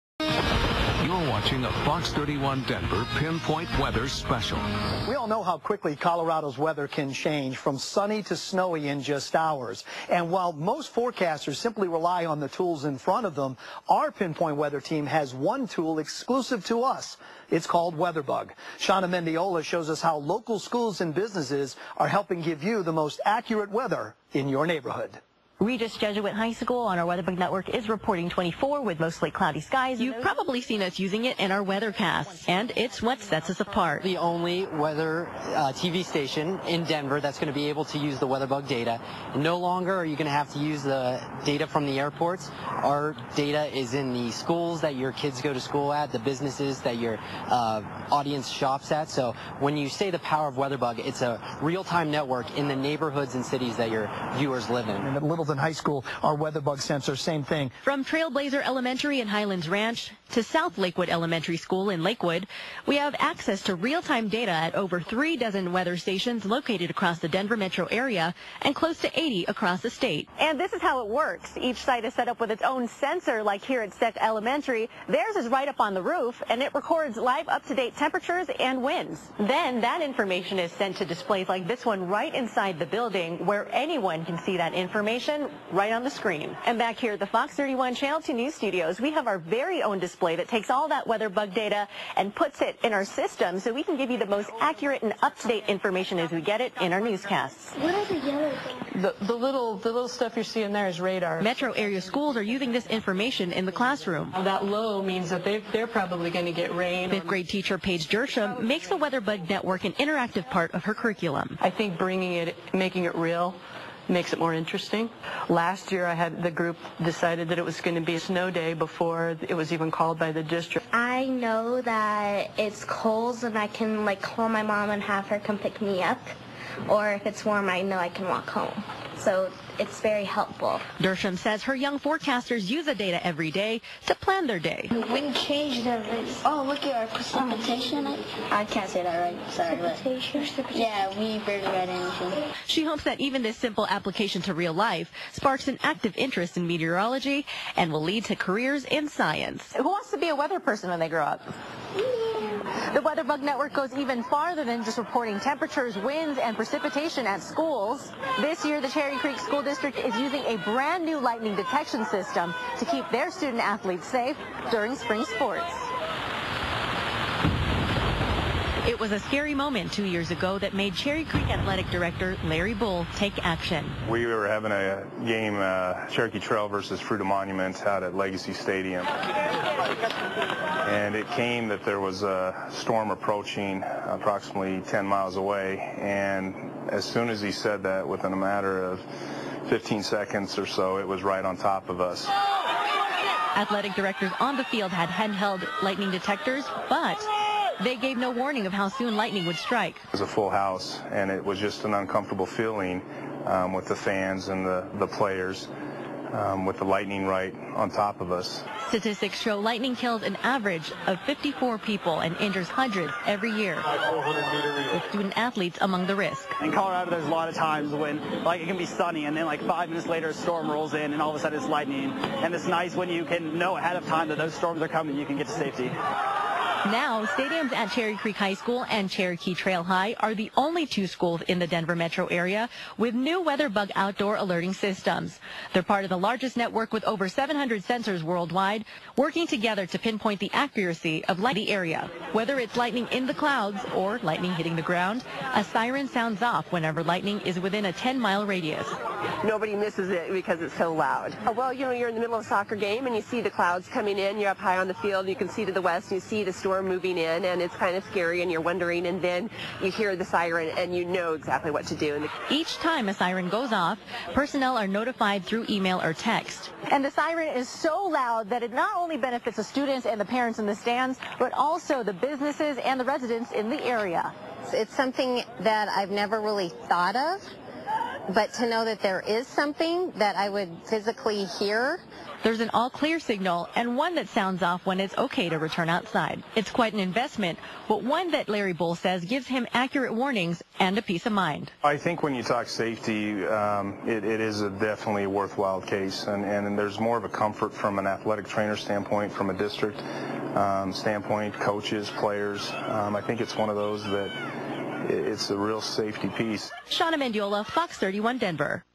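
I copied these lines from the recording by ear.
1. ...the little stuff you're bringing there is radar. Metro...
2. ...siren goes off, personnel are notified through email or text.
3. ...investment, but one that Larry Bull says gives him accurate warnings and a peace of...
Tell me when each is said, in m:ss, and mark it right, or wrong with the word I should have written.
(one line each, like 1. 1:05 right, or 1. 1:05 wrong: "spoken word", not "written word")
1. 1:39 wrong: "seeing", not "bringing"
2. 4:23 right
3. 4:46 right.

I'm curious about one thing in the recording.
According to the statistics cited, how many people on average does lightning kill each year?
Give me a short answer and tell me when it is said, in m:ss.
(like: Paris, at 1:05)
54, at 3:31.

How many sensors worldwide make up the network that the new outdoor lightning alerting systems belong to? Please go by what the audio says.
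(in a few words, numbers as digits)
700.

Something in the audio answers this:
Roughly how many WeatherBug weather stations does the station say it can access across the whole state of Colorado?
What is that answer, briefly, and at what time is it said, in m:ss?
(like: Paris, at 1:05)
80, at 1:08.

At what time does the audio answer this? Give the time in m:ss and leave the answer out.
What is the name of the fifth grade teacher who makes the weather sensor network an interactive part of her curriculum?
1:47.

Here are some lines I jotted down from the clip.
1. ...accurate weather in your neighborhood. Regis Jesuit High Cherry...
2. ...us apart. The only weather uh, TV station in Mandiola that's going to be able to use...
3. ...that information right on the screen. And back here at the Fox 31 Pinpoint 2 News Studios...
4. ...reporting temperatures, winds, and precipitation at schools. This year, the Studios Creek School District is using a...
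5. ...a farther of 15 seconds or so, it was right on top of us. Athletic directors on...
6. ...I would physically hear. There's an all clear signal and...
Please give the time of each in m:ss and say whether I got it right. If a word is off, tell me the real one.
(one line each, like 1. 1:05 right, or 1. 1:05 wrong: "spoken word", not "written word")
1. 0:23 wrong: "School", not "Cherry"
2. 0:33 wrong: "Denver", not "Mandiola"
3. 1:24 wrong: "Channel", not "Pinpoint"
4. 2:34 wrong: "Cherry", not "Studios"
5. 3:08 wrong: "matter", not "farther"
6. 4:40 right.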